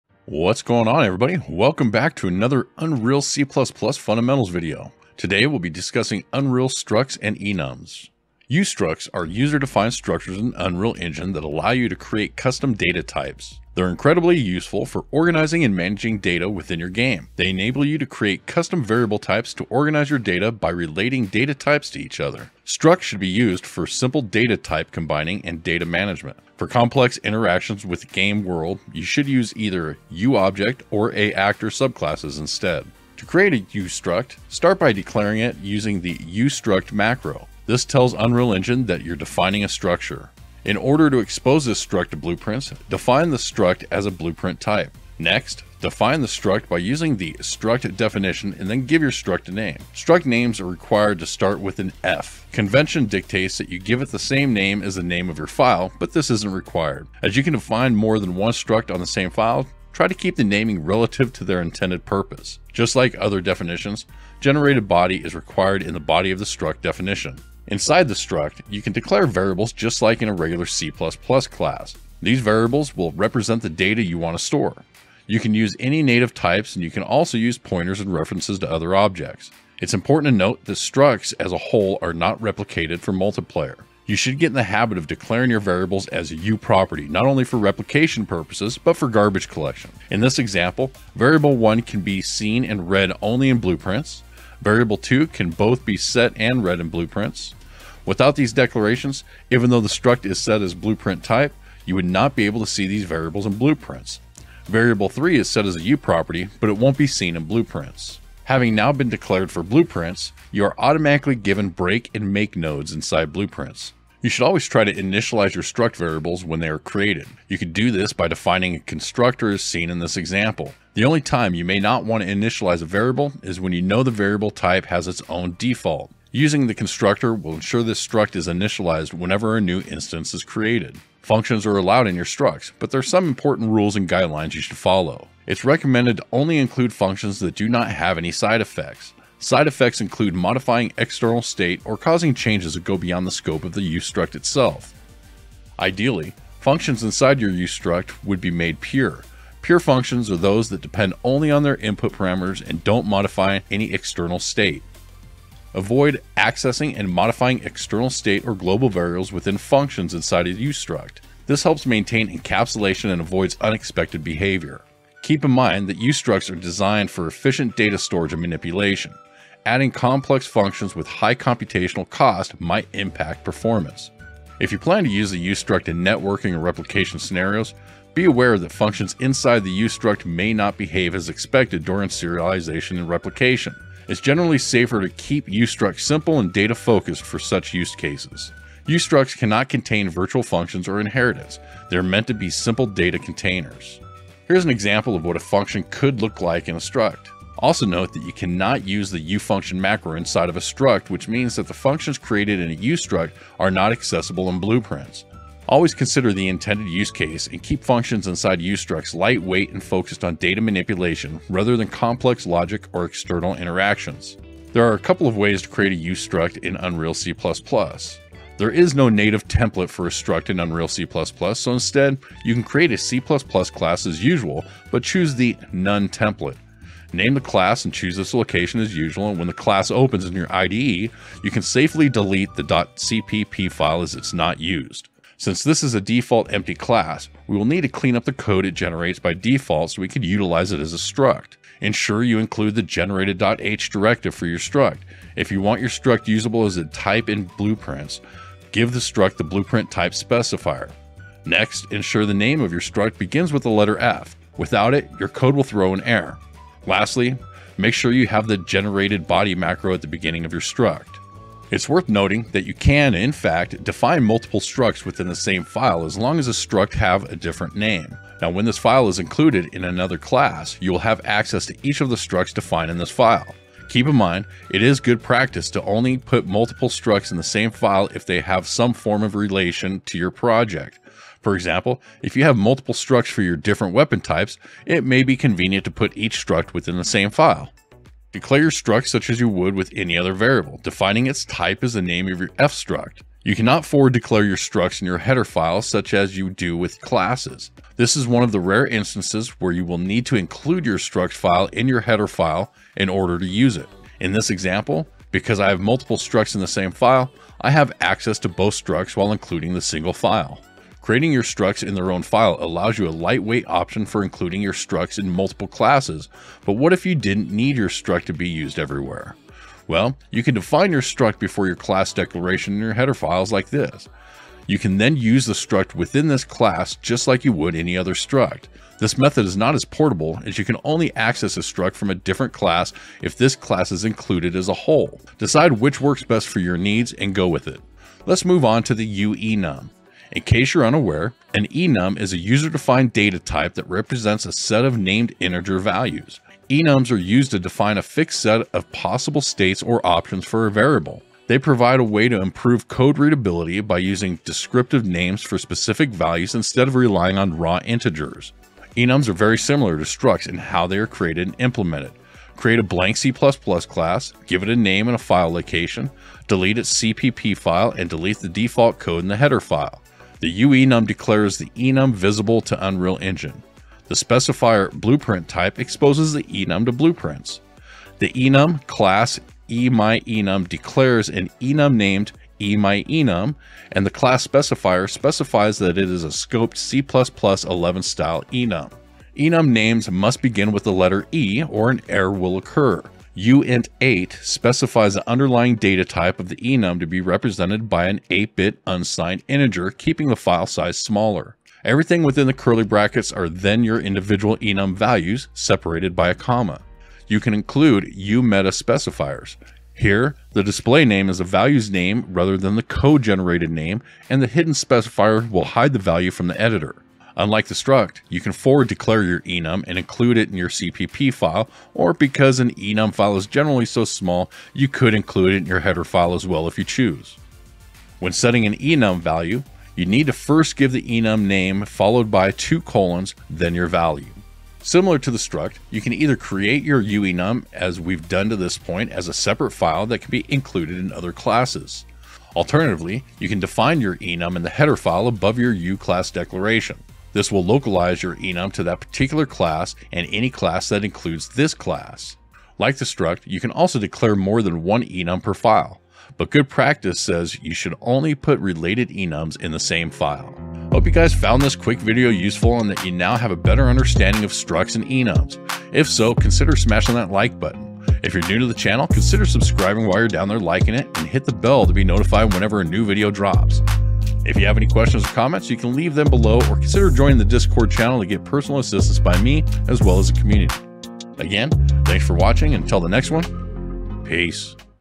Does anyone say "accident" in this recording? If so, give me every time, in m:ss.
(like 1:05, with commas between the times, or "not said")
not said.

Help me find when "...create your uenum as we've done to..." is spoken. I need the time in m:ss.
7:16.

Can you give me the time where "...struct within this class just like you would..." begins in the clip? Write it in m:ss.
5:25.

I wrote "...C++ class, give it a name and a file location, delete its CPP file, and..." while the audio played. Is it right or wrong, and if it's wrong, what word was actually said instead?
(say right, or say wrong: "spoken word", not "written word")
right.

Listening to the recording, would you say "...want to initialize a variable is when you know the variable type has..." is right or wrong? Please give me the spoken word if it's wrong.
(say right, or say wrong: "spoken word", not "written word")
right.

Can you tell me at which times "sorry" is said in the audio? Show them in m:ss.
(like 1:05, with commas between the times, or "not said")
not said.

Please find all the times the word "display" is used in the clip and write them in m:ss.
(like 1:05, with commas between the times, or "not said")
6:50.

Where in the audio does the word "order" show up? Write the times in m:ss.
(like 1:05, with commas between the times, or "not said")
0:40, 5:03.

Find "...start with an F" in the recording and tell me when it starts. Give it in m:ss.
0:51.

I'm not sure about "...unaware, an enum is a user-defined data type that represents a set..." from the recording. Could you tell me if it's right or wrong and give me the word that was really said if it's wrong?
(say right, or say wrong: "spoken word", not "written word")
right.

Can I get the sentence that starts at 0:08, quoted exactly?
Ustructs are user-defined structures in Unreal Engine that allow you to create custom data types.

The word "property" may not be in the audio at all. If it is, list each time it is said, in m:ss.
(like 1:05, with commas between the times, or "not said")
1:26, 1:45.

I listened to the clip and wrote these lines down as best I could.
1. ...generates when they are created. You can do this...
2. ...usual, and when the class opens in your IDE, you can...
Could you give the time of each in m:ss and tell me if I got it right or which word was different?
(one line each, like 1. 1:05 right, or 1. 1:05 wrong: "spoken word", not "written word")
1. 1:55 wrong: "variables", not "generates"
2. 3:48 right.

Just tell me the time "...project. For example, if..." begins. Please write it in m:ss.
4:40.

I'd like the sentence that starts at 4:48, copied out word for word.
Declare your struct such as you would with any other variable, defining its type as the name of your fstruct.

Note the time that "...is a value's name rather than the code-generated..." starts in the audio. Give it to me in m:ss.
6:51.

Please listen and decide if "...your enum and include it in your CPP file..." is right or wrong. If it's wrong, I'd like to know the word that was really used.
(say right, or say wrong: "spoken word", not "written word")
right.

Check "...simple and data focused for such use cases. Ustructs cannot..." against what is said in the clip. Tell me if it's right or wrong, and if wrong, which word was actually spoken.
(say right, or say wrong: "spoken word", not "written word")
right.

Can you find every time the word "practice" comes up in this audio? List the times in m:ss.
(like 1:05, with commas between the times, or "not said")
4:35, 7:36.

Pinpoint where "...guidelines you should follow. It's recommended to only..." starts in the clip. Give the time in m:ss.
2:14.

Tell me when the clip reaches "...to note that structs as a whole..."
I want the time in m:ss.
1:20.